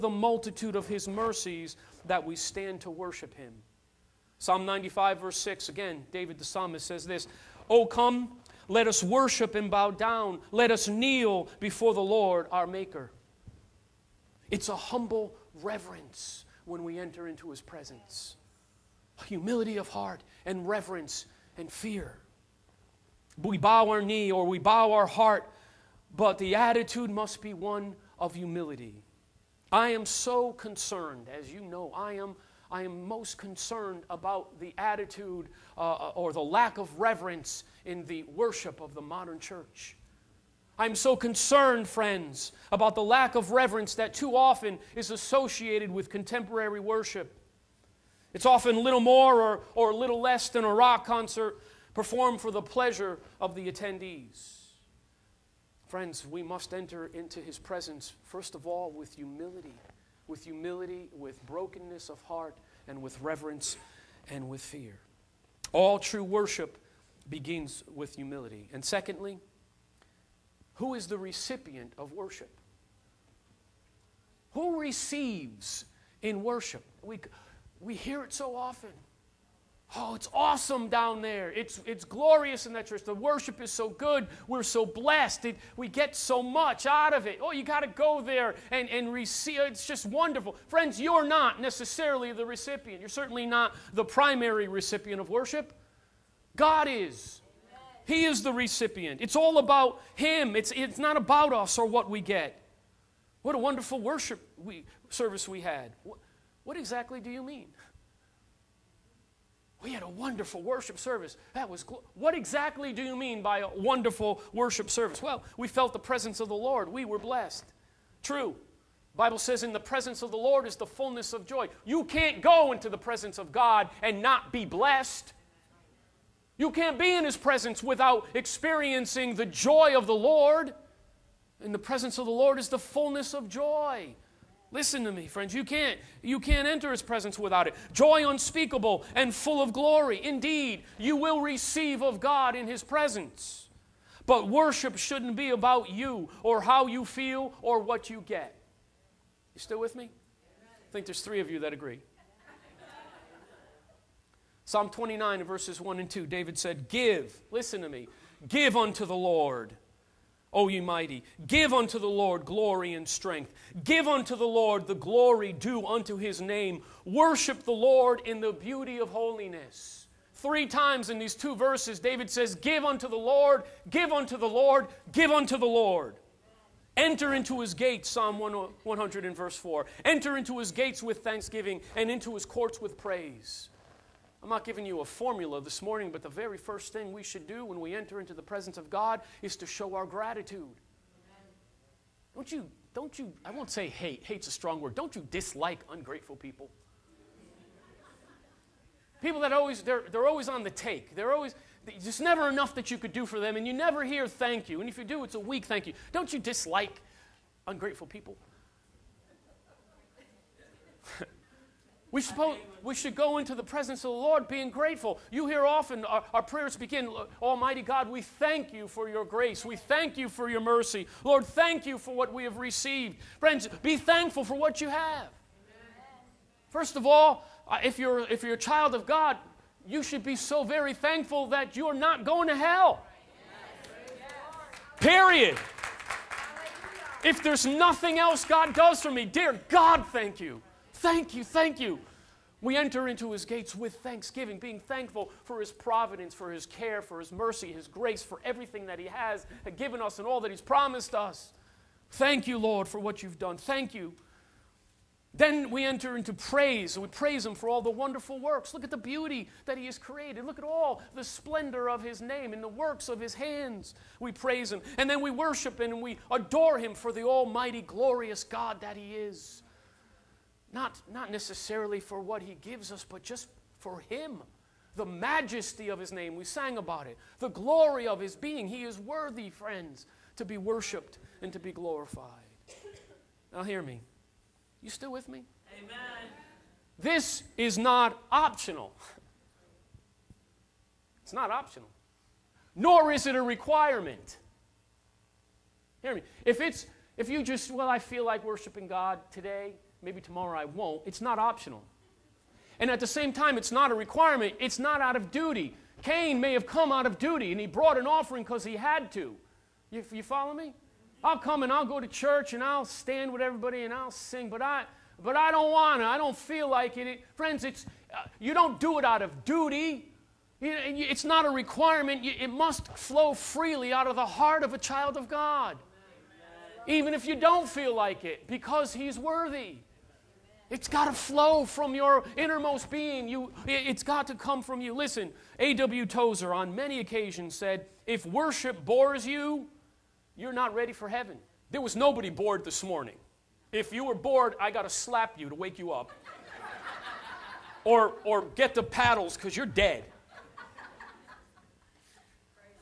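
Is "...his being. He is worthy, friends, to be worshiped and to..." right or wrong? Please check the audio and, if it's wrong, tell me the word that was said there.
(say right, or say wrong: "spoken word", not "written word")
right.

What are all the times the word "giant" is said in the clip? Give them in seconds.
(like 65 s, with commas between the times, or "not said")
not said.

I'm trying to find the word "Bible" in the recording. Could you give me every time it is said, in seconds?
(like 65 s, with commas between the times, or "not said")
119 s.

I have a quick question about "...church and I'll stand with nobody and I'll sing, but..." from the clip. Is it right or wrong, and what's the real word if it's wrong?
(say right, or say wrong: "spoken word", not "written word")
wrong: "everybody", not "nobody".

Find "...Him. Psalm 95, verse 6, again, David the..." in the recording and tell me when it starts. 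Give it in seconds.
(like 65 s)
3 s.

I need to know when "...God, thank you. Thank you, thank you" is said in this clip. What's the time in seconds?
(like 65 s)
239 s.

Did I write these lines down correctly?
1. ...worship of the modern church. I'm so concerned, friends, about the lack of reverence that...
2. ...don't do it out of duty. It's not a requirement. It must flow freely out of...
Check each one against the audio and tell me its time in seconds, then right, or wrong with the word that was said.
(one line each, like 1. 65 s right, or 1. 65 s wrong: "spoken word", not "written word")
1. 38 s right
2. 318 s right.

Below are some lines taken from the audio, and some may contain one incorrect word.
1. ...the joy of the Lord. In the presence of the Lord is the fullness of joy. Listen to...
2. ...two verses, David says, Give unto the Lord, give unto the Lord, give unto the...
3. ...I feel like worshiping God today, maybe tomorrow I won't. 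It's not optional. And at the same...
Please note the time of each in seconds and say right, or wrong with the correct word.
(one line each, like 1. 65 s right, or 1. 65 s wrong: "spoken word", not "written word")
1. 129 s right
2. 171 s right
3. 297 s right.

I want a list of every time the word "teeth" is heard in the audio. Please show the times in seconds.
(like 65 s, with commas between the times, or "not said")
not said.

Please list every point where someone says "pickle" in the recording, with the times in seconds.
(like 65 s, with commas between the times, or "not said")
not said.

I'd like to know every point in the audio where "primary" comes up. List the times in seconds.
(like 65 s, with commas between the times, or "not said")
94 s.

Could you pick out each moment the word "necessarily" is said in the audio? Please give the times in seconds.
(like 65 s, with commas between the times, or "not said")
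91 s, 271 s.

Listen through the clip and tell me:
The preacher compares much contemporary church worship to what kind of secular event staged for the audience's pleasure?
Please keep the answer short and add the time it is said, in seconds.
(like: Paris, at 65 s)
rock concert, at 50 s.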